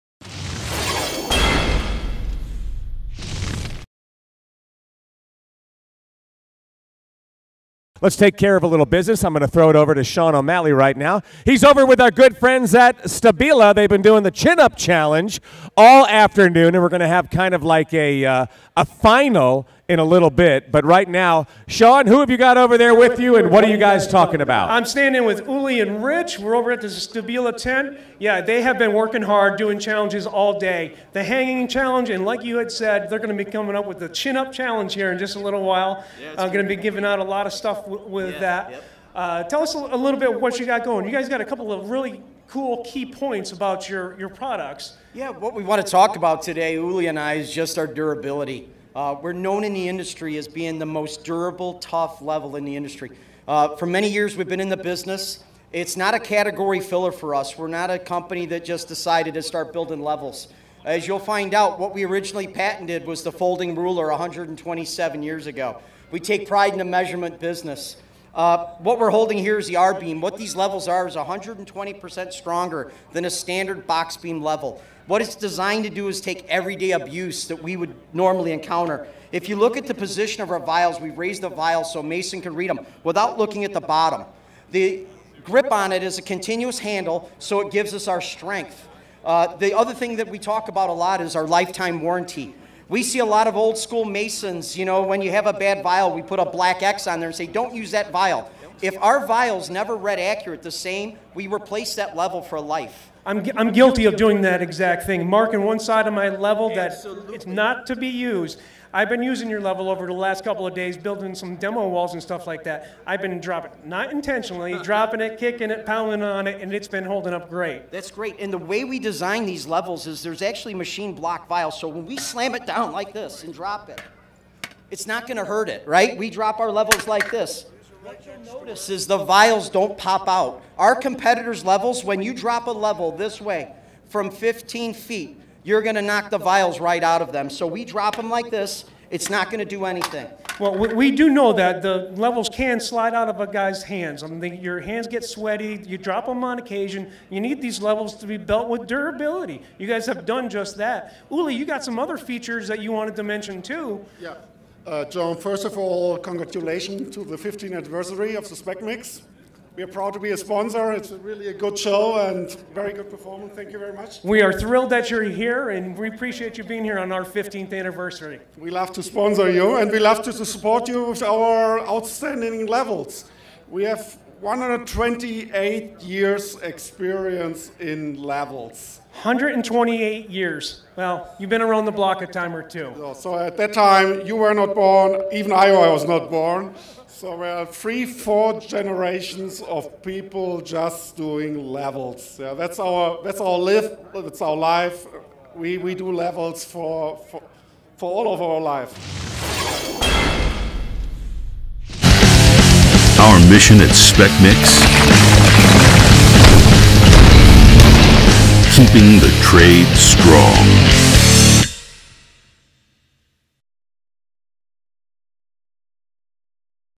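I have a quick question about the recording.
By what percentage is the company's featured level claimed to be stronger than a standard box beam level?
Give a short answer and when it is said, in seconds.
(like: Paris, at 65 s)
120%, at 71 s.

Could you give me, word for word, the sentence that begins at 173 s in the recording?
We have 128 years experience in levels.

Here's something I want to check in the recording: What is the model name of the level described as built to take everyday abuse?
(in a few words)
R-beam.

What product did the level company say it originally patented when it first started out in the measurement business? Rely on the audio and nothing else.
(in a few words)
the folding ruler.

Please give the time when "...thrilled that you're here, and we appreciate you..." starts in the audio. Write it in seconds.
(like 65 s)
164 s.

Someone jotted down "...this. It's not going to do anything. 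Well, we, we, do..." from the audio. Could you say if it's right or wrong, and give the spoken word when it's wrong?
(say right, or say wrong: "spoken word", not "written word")
right.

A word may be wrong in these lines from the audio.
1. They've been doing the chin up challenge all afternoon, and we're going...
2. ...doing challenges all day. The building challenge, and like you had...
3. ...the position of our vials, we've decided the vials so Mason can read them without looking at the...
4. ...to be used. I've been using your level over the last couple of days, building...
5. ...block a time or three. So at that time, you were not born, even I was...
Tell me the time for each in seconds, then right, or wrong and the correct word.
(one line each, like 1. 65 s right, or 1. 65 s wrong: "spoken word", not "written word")
1. 13 s right
2. 29 s wrong: "hanging", not "building"
3. 79 s wrong: "raised", not "decided"
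4. 107 s right
5. 181 s wrong: "two", not "three".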